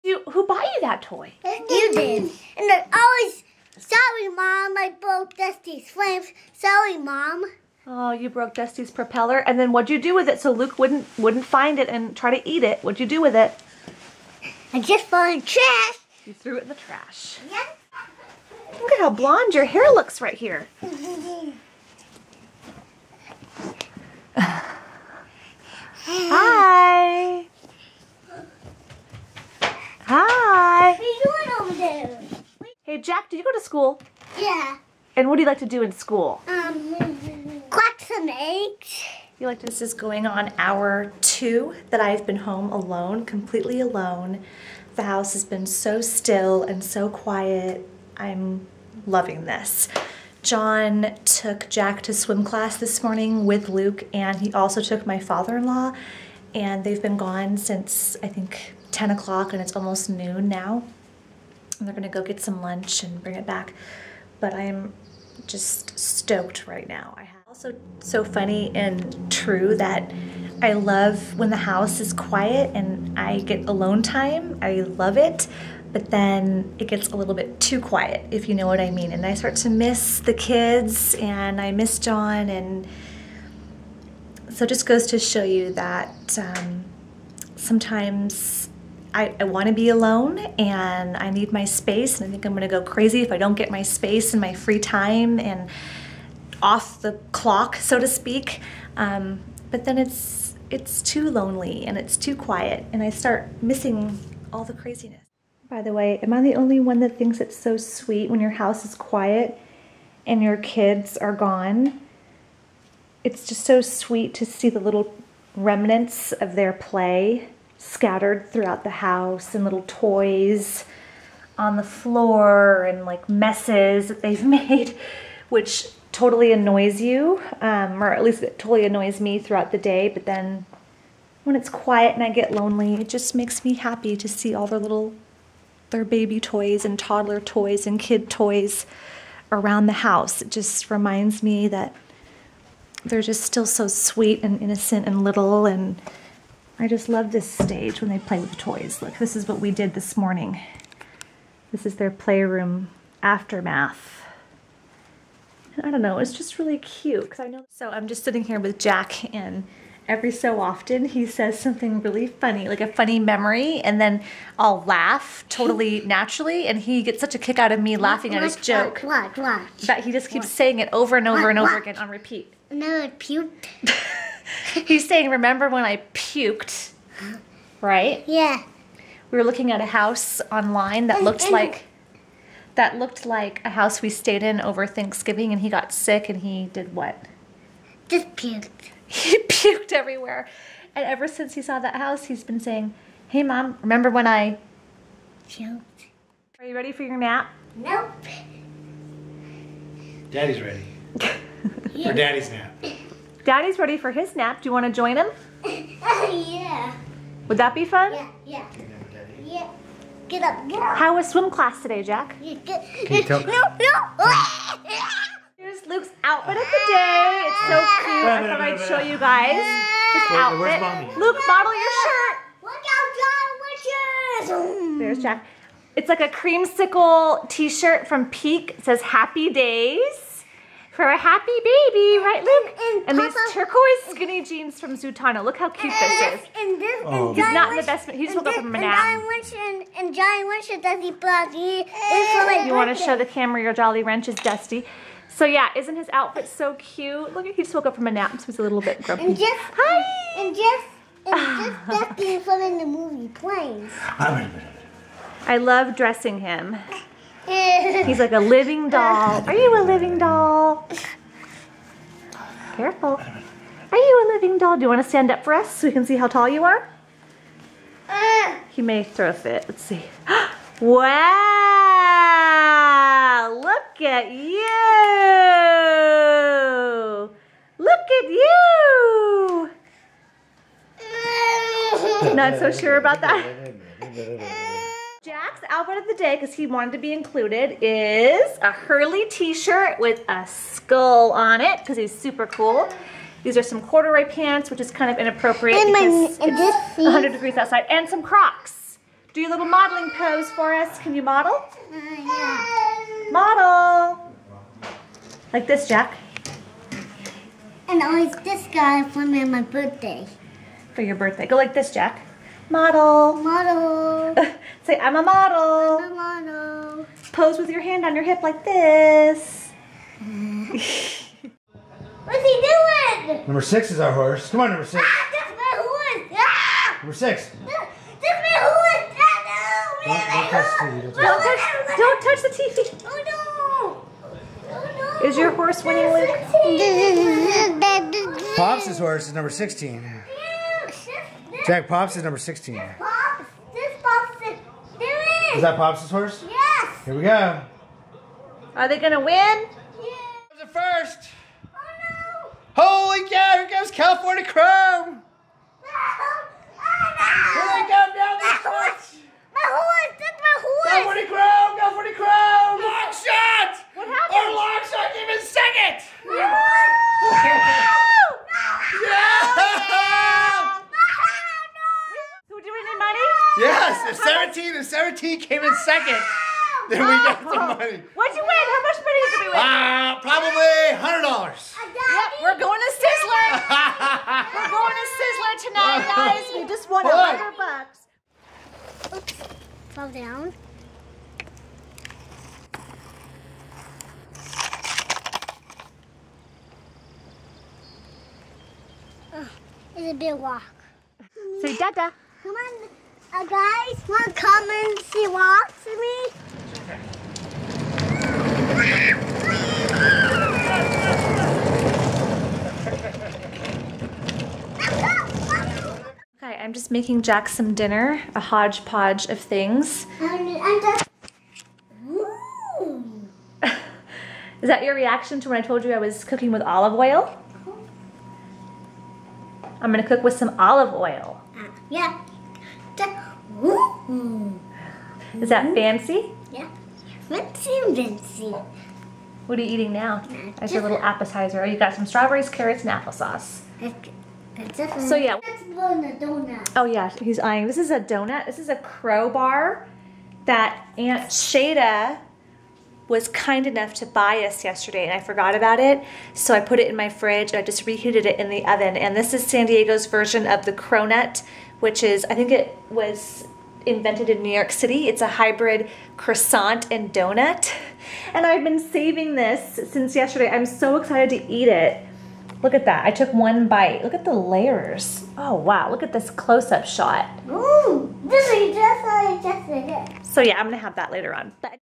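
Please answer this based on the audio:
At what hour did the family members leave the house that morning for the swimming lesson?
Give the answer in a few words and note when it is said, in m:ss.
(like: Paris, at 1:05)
10 o'clock, at 0:58.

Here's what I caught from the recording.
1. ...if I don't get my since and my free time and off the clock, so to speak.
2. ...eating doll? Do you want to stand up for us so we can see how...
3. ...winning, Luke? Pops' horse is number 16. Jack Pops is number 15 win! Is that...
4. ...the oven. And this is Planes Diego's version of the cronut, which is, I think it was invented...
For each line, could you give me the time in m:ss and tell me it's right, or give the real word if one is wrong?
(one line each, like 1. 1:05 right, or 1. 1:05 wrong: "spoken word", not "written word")
1. 1:33 wrong: "space", not "since"
2. 4:24 wrong: "living", not "eating"
3. 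5:35 wrong: "16", not "15"
4. 7:38 wrong: "San", not "Planes".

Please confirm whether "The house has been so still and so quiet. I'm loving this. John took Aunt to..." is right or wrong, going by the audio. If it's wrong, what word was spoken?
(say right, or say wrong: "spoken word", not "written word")
wrong: "Jack", not "Aunt".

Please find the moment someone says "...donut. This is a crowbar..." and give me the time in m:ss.
7:27.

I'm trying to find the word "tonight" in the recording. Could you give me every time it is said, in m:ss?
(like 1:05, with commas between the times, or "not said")
6:25.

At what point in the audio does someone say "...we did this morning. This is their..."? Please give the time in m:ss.
2:29.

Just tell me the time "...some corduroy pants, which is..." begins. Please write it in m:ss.
4:53.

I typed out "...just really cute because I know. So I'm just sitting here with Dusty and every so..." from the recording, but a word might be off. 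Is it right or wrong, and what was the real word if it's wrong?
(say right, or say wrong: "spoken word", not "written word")
wrong: "Jack", not "Dusty".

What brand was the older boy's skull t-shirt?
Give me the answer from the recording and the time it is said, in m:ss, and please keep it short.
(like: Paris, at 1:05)
Hurley, at 4:48.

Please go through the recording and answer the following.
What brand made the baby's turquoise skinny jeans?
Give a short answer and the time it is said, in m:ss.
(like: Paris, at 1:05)
Zutano, at 3:54.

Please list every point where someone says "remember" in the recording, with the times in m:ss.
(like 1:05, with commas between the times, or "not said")
2:55, 3:13.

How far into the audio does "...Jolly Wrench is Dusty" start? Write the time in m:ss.
4:03.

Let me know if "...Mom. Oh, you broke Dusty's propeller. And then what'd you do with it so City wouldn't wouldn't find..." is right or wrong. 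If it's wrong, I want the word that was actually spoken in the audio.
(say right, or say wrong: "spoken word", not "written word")
wrong: "Luke", not "City".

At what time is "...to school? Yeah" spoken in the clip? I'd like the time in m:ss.
0:33.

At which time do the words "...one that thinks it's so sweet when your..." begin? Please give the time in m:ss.
1:46.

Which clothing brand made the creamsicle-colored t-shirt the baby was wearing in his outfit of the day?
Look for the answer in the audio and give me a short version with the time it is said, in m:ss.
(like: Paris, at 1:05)
Peek, at 3:48.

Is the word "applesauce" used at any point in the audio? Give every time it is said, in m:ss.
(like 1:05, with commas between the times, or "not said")
7:22.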